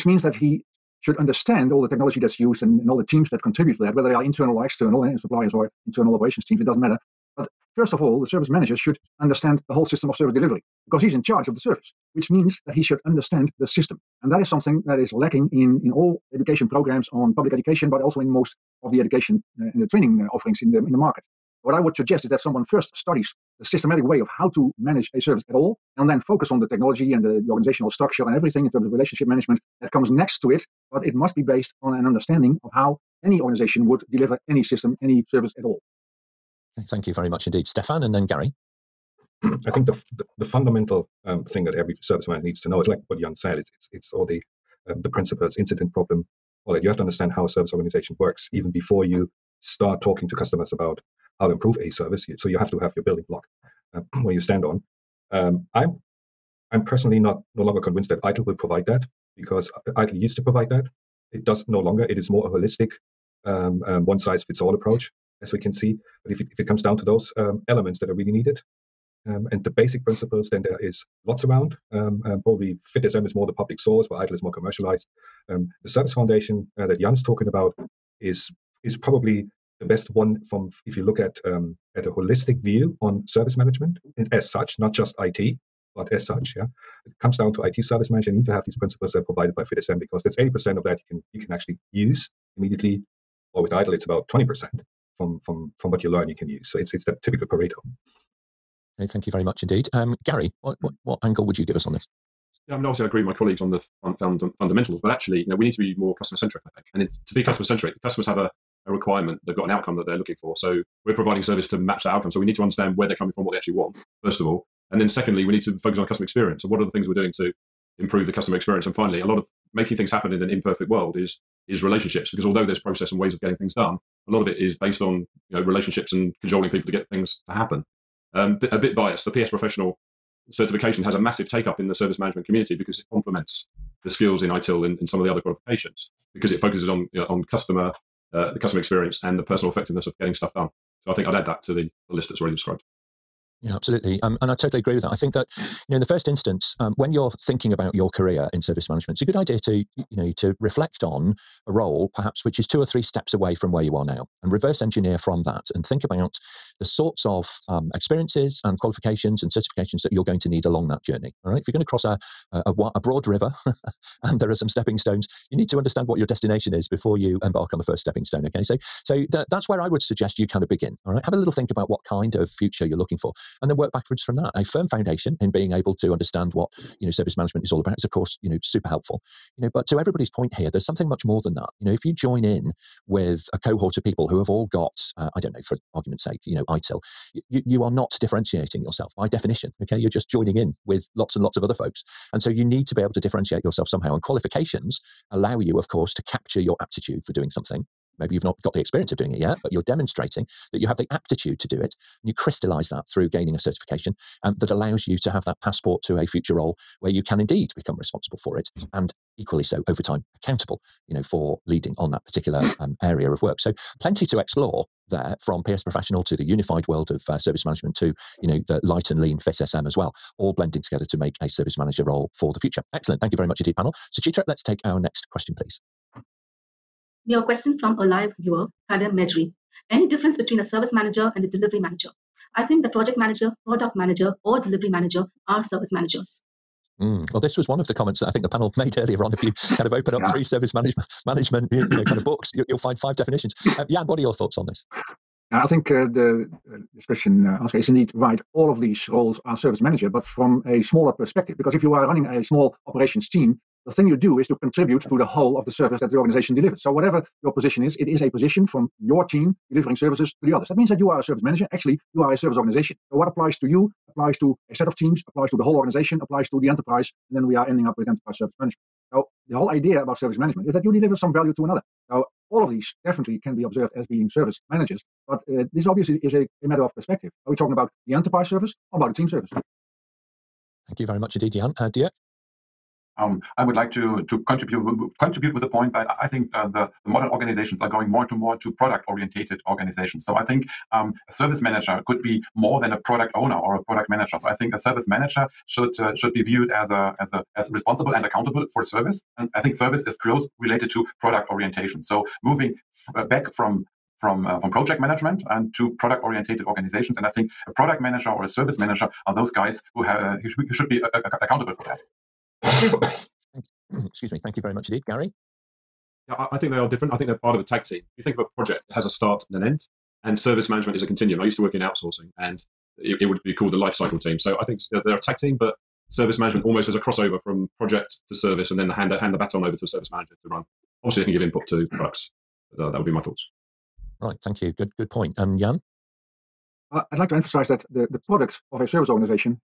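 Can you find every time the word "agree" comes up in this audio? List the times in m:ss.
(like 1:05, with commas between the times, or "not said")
1:43, 2:24.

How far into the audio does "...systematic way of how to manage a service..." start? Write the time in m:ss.
0:23.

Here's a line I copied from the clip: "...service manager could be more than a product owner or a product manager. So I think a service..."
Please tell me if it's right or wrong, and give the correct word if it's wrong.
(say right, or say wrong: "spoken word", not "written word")
right.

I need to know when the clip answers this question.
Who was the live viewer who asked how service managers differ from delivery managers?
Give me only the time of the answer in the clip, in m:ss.
3:48.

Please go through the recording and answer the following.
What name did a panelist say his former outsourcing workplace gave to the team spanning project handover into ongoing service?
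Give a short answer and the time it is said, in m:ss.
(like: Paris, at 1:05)
life cycle team, at 5:23.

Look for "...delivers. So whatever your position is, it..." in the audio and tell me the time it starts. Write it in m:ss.
4:16.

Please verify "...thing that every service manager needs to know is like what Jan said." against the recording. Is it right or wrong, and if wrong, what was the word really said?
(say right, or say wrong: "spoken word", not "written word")
right.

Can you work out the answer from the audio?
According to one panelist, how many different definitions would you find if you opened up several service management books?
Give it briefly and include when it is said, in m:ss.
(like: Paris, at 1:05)
5, at 4:02.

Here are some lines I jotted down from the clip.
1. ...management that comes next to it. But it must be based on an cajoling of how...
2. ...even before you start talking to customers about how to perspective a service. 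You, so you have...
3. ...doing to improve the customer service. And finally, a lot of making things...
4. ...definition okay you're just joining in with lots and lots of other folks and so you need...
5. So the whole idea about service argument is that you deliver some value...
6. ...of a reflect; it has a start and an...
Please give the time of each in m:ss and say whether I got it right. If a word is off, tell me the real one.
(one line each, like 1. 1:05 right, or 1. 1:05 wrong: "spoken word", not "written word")
1. 0:29 wrong: "understanding", not "cajoling"
2. 0:48 wrong: "improve", not "perspective"
3. 1:57 wrong: "experience", not "service"
4. 3:09 right
5. 4:29 wrong: "management", not "argument"
6. 5:18 wrong: "project", not "reflect".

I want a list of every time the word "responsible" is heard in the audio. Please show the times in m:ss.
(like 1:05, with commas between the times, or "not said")
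3:27, 4:57.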